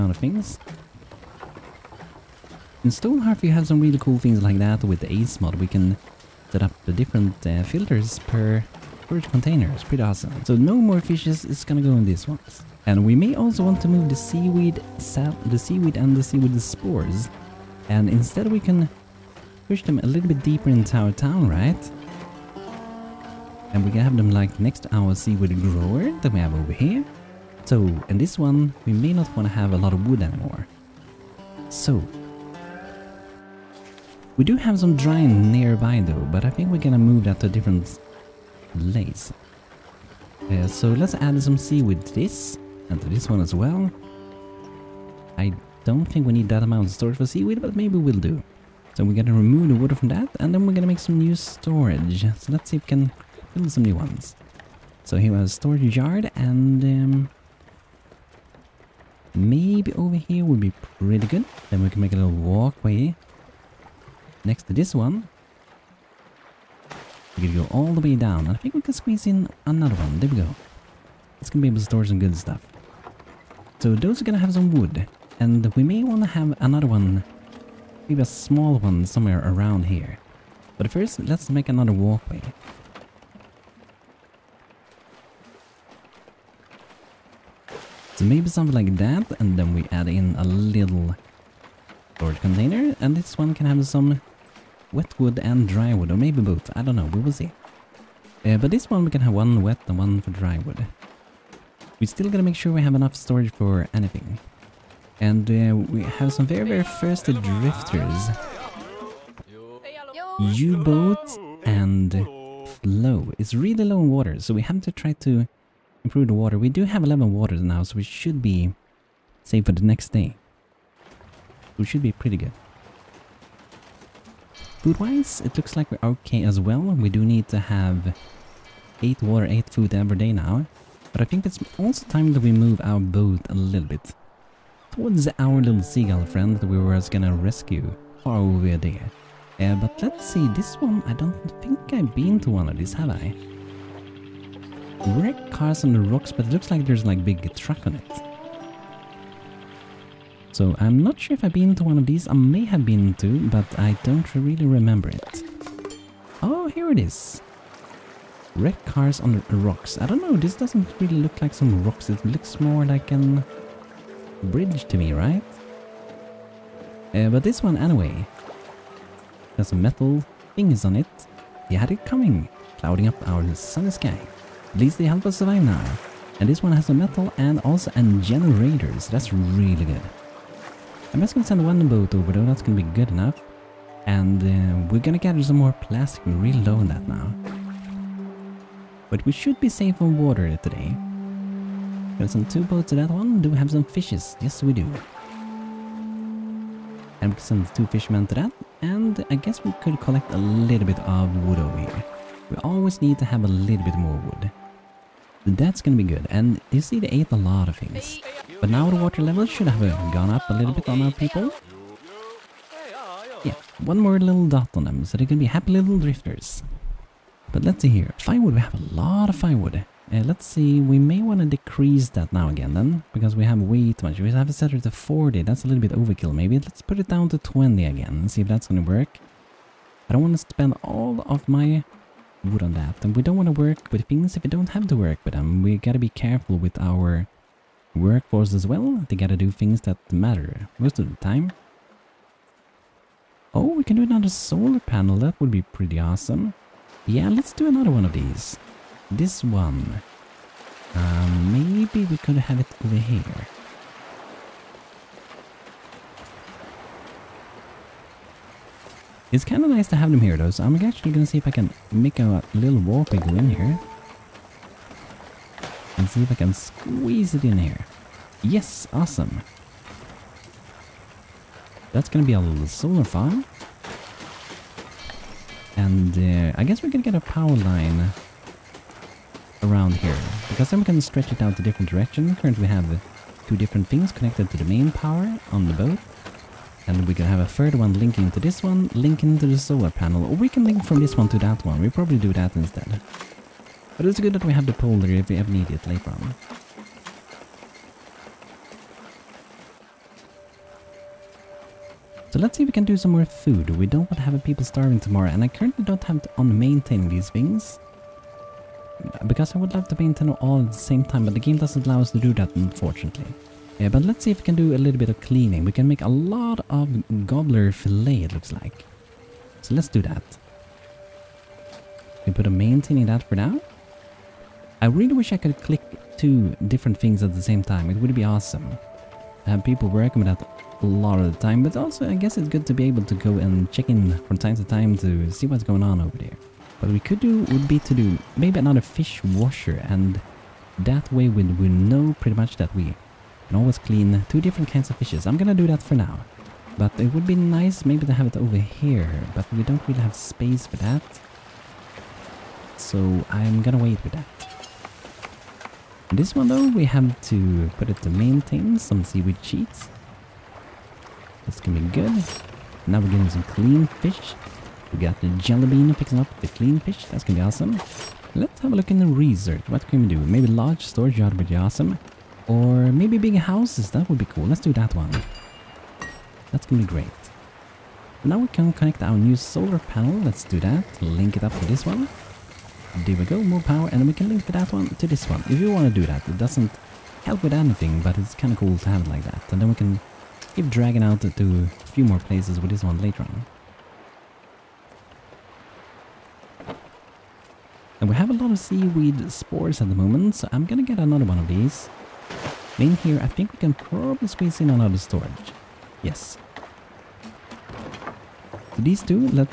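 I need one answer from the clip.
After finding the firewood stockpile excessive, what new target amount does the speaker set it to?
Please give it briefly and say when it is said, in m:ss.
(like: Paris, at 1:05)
20, at 3:47.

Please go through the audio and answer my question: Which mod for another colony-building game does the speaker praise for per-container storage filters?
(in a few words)
ACE mod.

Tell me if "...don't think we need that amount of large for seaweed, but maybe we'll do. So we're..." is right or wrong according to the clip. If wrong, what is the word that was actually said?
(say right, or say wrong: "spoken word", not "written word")
wrong: "storage", not "large".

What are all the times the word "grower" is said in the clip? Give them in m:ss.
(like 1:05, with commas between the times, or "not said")
0:25.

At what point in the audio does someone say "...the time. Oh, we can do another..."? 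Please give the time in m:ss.
4:01.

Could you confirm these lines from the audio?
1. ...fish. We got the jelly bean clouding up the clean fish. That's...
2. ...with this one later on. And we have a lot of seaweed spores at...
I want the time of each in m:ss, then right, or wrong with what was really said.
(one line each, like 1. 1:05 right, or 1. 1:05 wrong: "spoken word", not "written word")
1. 6:03 wrong: "picking", not "clouding"
2. 6:32 right.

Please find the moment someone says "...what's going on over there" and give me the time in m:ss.
5:35.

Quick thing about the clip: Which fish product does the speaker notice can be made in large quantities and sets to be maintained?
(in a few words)
Gobbler fillet.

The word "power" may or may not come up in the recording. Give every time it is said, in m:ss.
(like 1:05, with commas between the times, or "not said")
4:37, 4:44, 6:23.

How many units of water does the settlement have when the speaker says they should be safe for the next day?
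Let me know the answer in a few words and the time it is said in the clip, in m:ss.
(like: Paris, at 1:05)
11, at 1:57.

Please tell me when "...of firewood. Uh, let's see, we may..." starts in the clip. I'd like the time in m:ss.
3:39.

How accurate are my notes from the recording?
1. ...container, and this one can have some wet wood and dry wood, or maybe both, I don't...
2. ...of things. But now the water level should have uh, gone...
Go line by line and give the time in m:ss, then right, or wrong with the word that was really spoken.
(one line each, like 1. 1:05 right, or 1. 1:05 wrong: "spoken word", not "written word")
1. 1:32 right
2. 3:27 right.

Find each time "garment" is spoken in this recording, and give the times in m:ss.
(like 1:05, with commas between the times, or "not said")
not said.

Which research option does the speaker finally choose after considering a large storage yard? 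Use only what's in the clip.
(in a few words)
Big houses.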